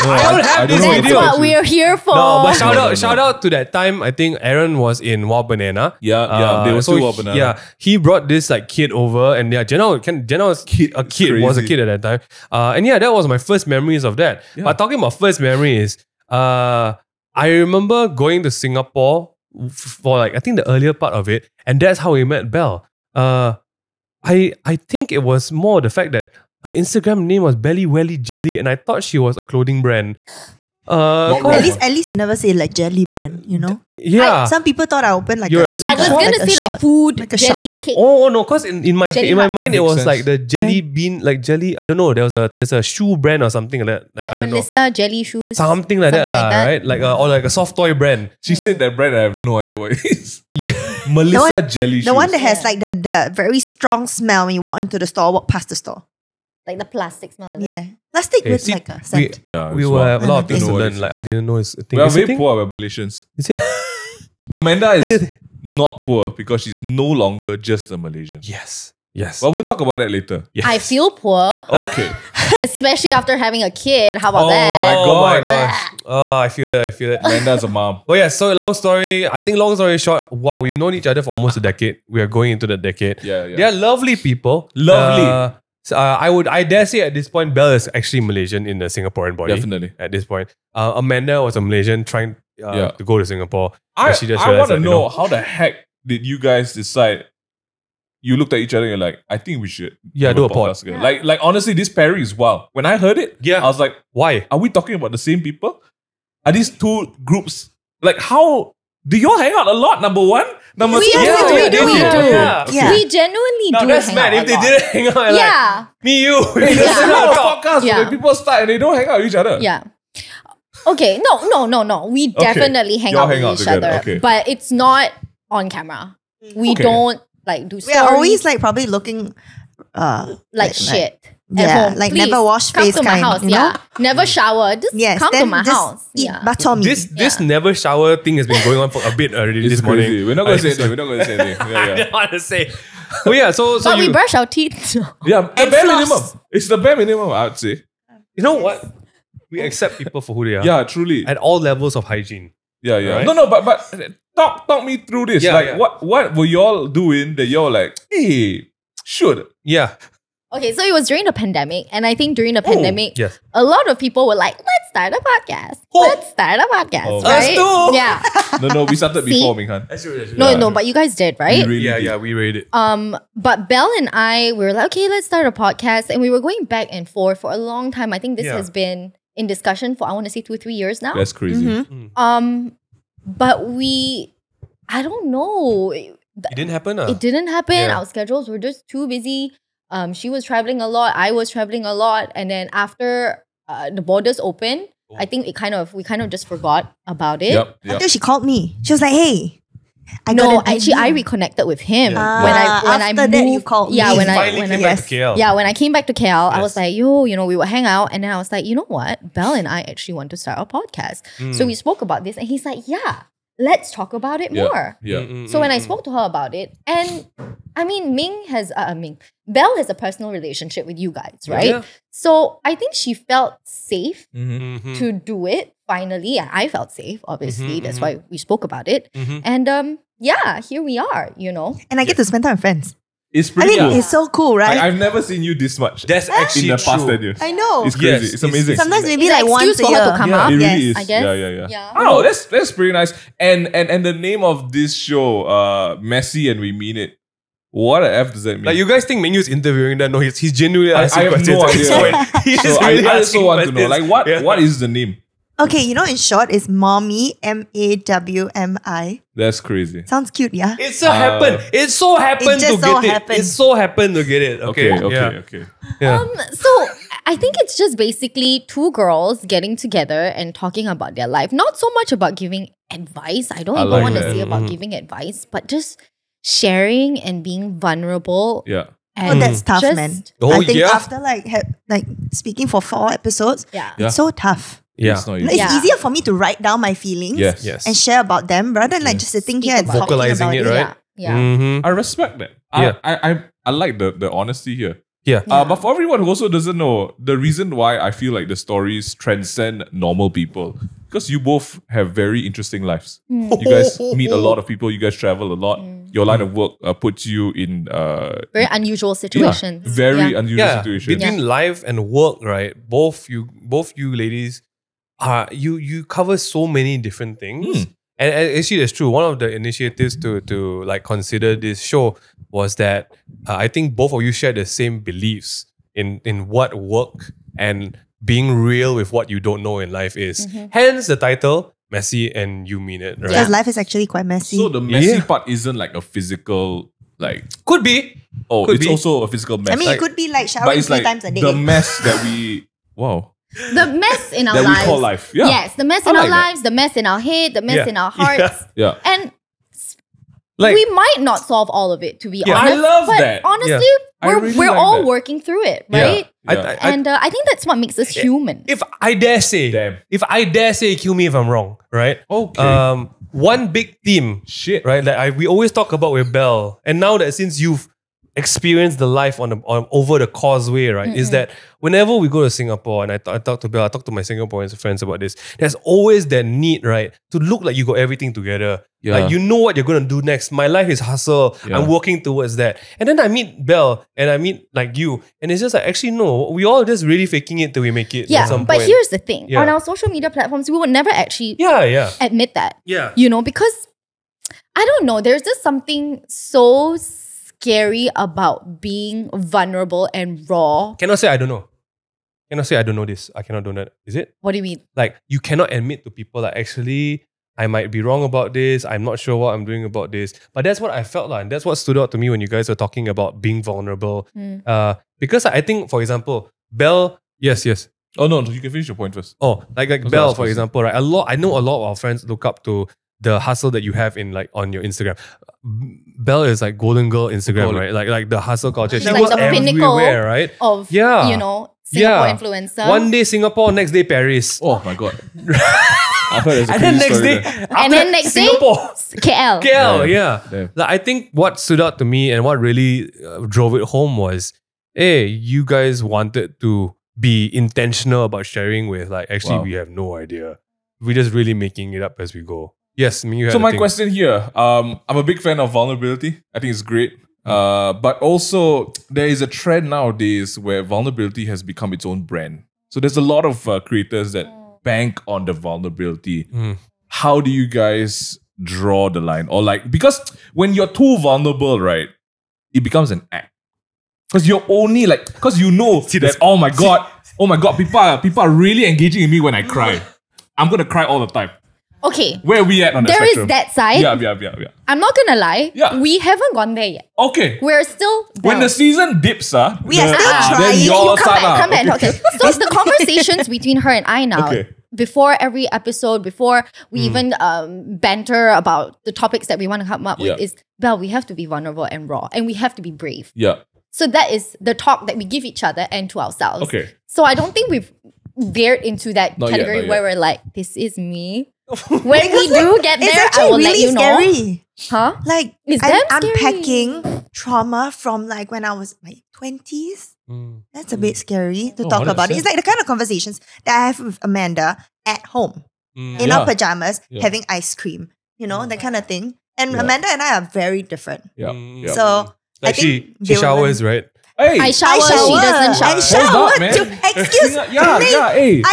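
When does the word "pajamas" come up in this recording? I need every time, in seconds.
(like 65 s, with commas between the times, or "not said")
526 s.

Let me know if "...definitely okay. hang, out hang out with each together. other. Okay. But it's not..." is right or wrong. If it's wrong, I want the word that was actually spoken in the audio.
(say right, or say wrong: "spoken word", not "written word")
right.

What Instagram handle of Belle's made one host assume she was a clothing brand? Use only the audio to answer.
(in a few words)
Belly Welly Jelly.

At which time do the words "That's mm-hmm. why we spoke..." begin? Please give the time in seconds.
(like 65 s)
227 s.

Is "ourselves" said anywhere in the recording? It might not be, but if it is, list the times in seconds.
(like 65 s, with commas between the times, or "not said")
506 s.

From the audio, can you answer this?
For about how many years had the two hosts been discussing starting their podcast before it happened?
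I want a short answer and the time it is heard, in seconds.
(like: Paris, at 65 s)
two, three years, at 180 s.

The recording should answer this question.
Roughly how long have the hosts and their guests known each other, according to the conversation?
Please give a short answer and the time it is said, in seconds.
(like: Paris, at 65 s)
almost a decade, at 81 s.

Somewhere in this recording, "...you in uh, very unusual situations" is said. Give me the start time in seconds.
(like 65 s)
307 s.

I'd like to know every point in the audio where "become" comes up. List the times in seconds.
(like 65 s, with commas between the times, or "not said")
461 s, 472 s.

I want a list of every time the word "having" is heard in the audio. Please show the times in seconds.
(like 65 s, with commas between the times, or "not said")
73 s, 527 s.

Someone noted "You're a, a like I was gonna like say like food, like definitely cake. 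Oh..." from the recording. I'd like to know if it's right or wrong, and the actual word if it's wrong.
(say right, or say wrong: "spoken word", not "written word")
wrong: "jelly", not "definitely".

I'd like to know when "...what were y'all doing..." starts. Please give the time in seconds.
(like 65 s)
156 s.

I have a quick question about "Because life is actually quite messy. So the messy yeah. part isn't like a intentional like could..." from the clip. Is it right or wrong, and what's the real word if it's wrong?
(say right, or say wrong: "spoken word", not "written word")
wrong: "physical", not "intentional".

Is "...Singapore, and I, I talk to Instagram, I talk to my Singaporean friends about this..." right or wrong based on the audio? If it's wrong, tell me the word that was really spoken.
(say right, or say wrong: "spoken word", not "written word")
wrong: "Bill", not "Instagram".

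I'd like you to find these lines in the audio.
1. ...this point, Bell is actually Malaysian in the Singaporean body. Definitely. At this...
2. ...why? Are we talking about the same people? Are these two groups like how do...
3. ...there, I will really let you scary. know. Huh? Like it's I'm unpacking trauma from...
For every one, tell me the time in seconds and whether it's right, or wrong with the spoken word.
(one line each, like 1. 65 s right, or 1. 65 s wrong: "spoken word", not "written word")
1. 87 s right
2. 104 s right
3. 512 s right.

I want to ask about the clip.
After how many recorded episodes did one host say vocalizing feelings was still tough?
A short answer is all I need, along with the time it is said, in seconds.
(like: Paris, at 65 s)
4, at 282 s.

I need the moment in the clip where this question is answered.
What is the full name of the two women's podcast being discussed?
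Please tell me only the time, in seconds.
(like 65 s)
245 s.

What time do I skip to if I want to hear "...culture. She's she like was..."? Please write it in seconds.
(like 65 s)
428 s.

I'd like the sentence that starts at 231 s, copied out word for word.
And I get to spend time with friends.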